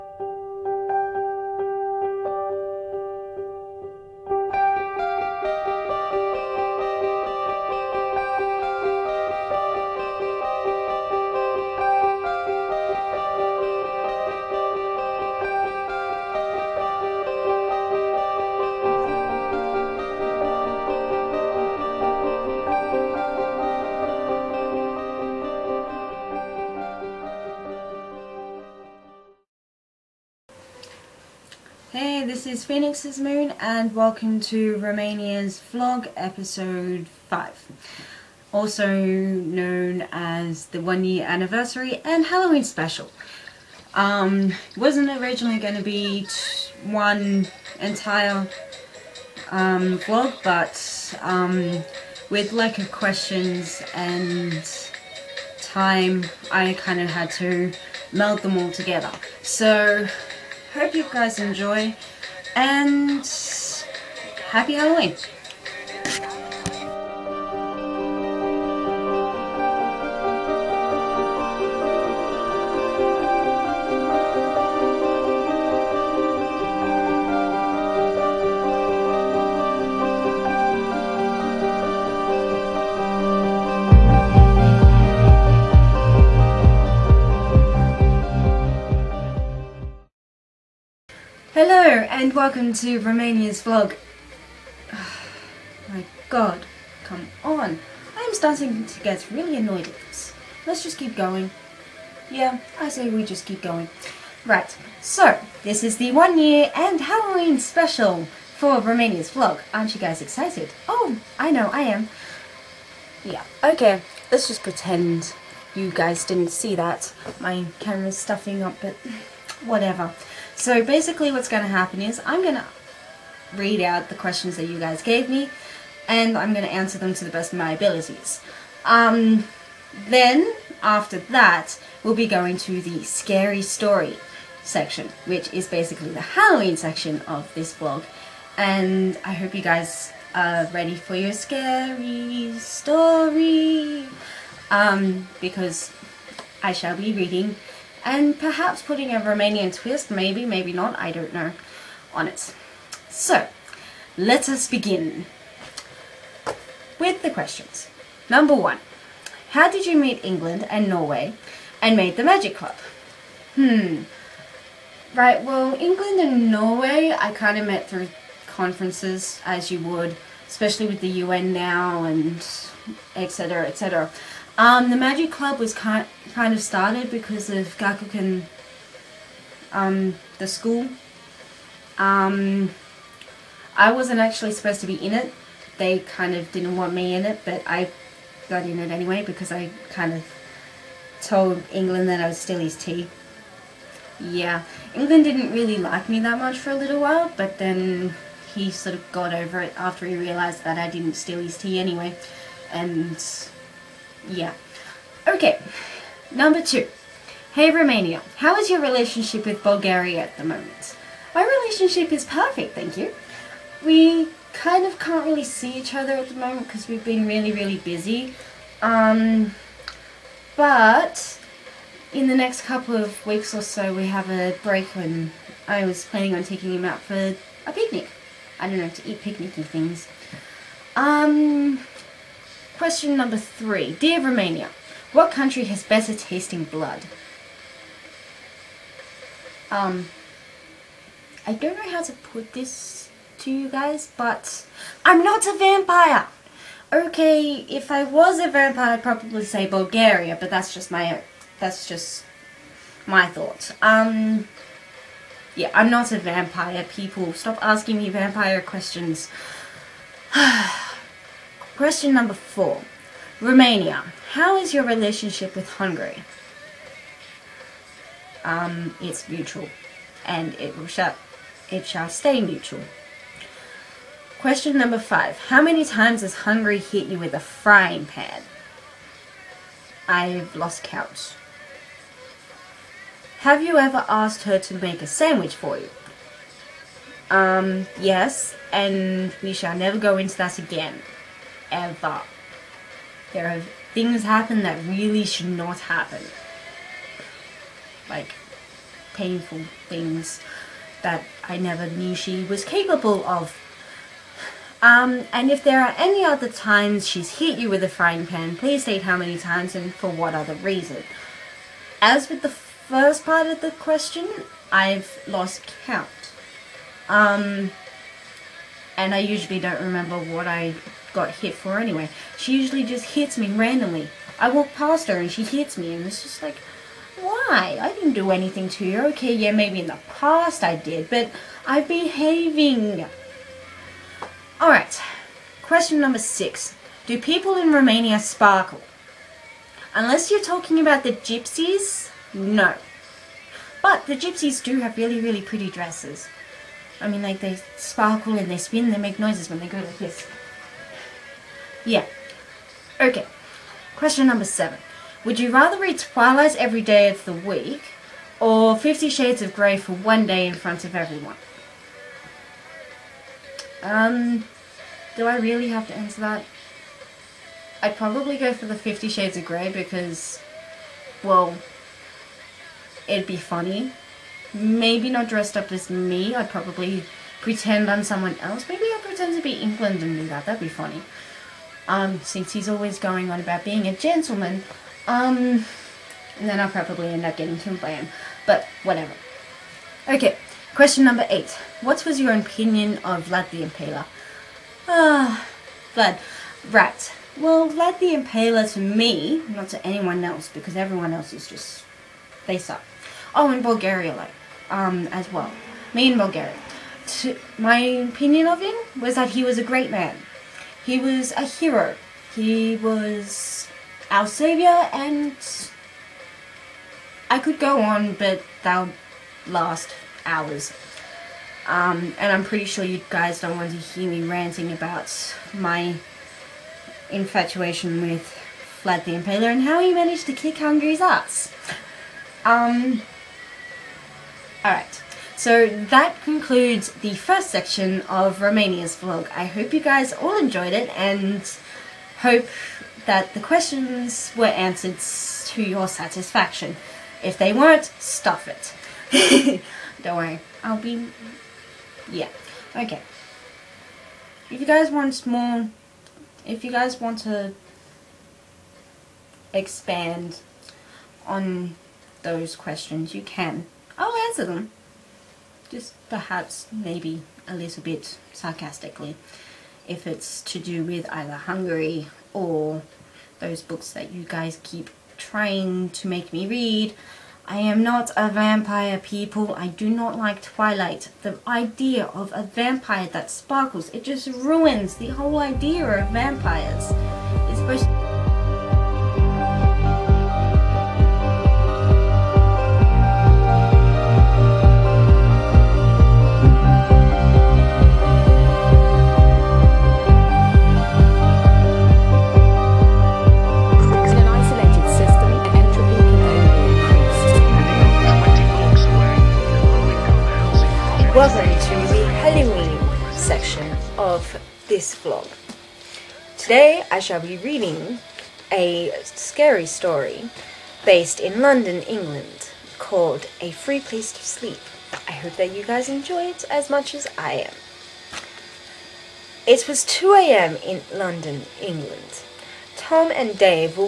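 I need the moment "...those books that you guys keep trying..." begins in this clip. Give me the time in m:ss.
7:53.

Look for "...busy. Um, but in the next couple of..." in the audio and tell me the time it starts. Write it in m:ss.
3:37.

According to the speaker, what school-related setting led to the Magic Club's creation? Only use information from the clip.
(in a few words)
Gakuen.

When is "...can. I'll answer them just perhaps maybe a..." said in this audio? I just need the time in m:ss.
7:43.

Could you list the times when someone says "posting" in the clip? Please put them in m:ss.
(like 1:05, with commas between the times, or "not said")
not said.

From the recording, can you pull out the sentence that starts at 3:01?
Um, I wasn't actually supposed to be in it.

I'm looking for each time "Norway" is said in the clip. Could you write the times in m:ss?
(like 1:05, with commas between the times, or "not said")
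2:40, 2:46.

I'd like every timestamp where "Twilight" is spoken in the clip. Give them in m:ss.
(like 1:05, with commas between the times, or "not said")
5:55, 8:00.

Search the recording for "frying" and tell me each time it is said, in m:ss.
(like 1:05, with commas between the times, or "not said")
4:37, 5:07.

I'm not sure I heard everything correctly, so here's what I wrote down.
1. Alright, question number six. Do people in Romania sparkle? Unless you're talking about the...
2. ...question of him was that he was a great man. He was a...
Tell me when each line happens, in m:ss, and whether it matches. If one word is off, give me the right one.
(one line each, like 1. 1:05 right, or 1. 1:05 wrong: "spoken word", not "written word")
1. 5:34 right
2. 6:47 wrong: "opinion", not "question".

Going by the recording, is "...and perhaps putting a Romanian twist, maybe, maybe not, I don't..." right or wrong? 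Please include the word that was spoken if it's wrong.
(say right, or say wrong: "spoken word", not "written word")
right.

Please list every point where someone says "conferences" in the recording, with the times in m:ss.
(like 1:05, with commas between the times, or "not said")
2:48.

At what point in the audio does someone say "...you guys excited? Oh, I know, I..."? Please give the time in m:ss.
1:49.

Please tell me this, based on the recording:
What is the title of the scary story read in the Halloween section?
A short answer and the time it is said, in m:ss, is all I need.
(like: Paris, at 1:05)
A Free Place to Sleep, at 8:43.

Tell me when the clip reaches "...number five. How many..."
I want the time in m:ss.
4:34.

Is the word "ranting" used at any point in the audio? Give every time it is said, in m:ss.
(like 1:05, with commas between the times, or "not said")
7:04.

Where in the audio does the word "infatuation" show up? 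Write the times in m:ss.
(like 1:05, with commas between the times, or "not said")
7:07.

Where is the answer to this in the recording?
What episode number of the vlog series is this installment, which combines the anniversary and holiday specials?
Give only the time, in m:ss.
0:36.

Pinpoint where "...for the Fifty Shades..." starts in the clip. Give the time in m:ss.
6:08.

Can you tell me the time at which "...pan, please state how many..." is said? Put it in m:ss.
5:08.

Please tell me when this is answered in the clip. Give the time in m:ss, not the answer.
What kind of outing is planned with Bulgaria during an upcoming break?
3:47.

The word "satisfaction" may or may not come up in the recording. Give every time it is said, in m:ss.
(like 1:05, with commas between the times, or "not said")
7:25.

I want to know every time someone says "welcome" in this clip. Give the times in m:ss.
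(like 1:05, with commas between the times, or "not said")
0:33, 1:32.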